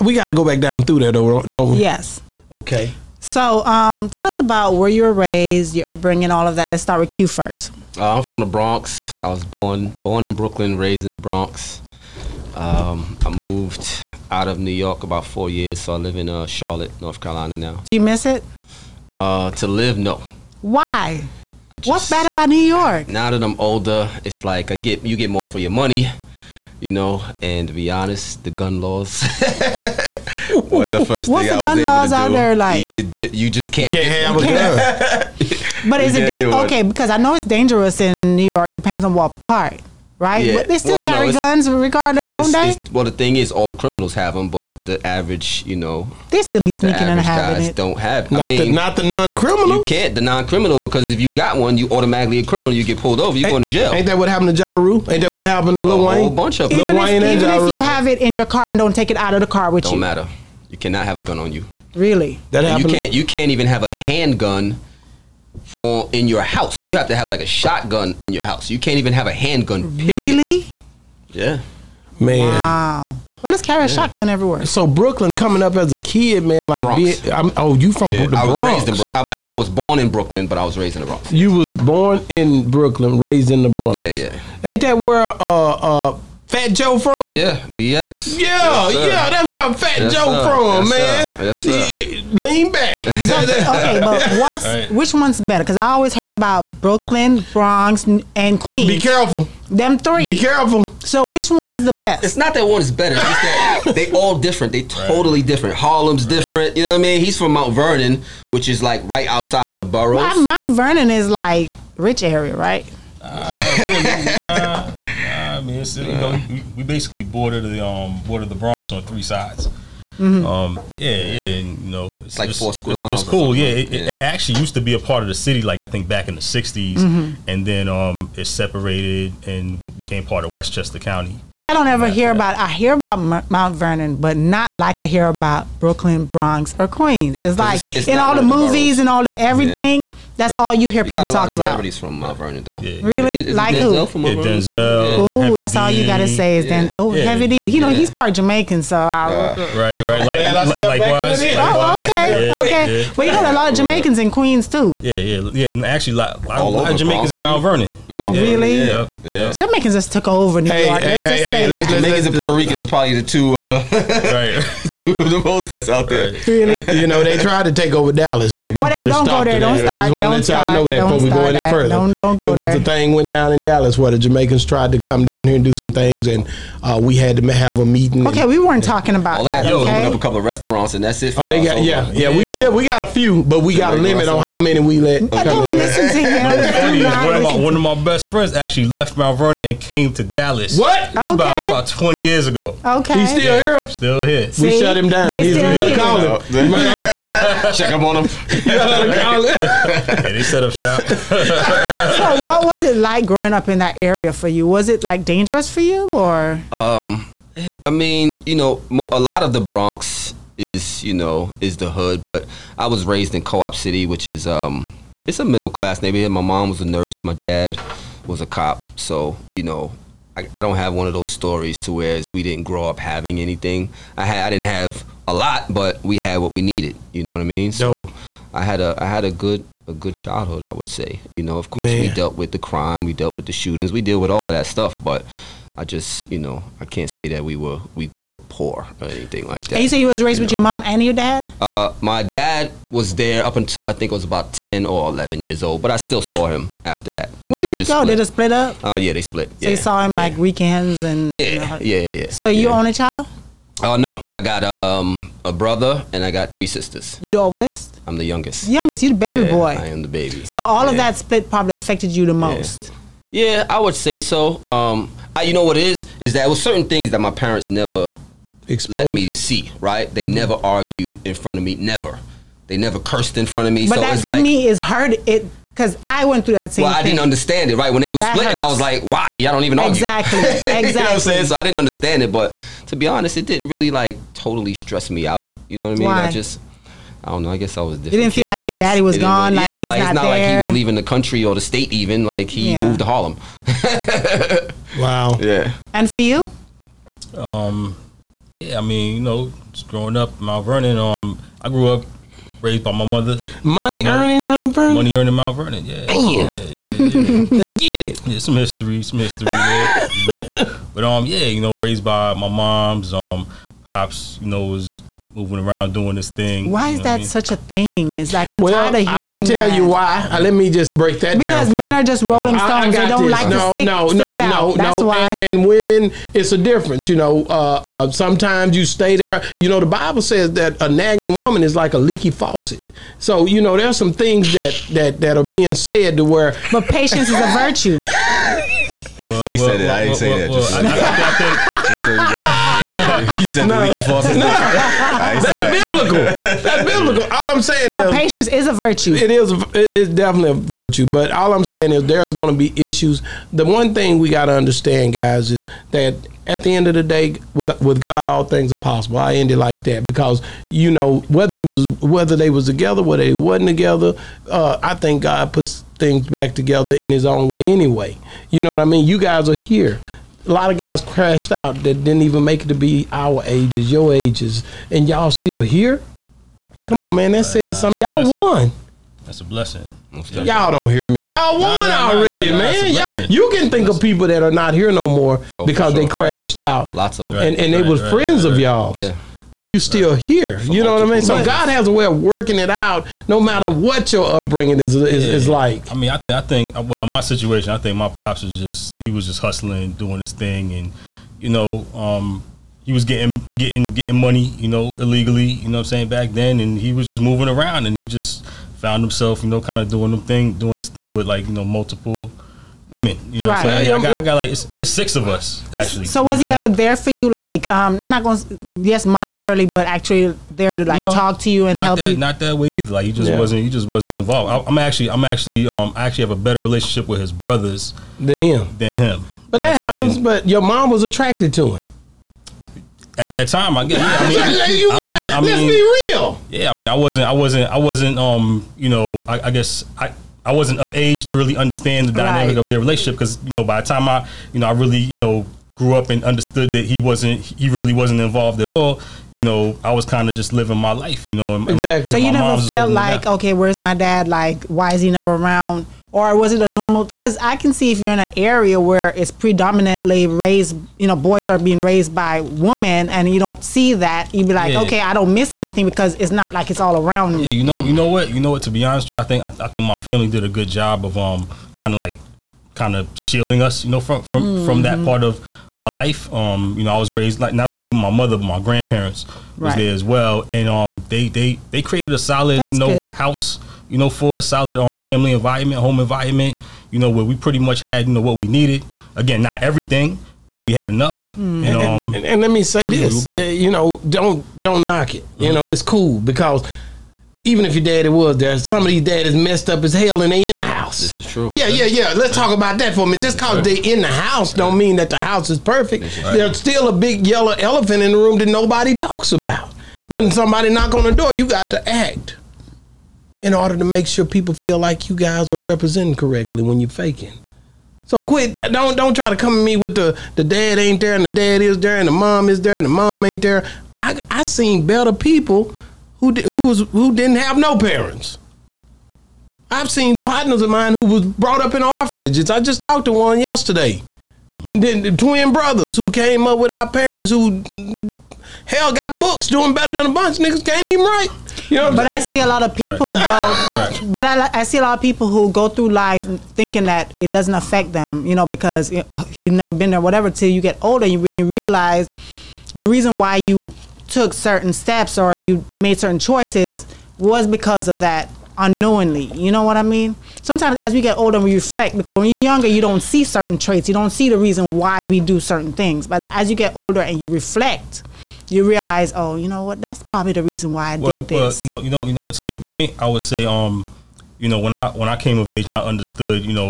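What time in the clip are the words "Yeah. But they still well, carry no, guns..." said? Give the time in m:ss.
0:40.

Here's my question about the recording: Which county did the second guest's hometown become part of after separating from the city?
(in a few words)
Westchester County.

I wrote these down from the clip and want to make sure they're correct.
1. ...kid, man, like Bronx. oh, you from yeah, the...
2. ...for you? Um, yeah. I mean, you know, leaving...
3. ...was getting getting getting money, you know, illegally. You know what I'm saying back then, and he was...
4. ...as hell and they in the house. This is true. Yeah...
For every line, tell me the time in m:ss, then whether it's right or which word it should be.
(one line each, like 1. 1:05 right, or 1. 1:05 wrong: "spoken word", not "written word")
1. 1:15 right
2. 4:56 wrong: "growing", not "leaving"
3. 6:42 right
4. 8:19 right.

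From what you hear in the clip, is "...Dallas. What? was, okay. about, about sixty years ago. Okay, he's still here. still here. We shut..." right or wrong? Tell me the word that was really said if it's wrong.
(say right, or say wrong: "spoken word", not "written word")
wrong: "twenty", not "sixty".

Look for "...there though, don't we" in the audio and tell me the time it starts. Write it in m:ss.
0:00.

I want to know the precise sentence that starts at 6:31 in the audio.
So God has a way of working it out, no matter what your upbringing is is, yeah.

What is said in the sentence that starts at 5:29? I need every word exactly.
You know, the Bible says that a nagging woman is like a leaky faucet.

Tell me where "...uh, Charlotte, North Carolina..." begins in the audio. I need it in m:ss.
0:16.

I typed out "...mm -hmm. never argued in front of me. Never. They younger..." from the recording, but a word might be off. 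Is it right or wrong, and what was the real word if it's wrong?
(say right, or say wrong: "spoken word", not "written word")
wrong: "never", not "younger".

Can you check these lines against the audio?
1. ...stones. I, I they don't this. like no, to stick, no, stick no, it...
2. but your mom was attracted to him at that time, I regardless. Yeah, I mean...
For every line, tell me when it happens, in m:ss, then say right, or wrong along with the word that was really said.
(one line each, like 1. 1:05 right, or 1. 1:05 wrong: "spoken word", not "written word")
1. 5:22 right
2. 7:10 wrong: "guess", not "regardless".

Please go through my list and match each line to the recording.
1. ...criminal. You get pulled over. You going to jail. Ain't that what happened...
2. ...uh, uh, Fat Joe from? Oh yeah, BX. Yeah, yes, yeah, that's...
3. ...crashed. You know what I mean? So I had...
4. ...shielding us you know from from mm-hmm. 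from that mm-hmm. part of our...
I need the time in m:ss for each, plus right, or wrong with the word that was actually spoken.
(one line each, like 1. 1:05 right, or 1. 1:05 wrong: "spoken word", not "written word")
1. 0:52 right
2. 1:25 right
3. 3:46 wrong: "needed", not "crashed"
4. 7:53 right.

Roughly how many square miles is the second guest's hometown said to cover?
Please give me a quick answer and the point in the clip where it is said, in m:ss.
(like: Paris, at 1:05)
4 square miles, at 2:02.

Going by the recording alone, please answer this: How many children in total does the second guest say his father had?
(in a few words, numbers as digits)
6.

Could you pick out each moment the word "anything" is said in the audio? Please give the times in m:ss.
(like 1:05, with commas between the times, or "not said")
3:43, 3:59, 7:45.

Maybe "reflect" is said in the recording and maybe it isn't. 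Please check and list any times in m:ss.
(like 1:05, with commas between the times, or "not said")
9:21, 9:27.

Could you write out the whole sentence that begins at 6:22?
Y'all, you can think of people that are not here no more oh, because sure, they crashed right.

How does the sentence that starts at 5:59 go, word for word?
I ended like that because you know whether you was whether they was together, whether they wasn't together.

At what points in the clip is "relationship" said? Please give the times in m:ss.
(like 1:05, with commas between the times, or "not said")
7:06, 7:22.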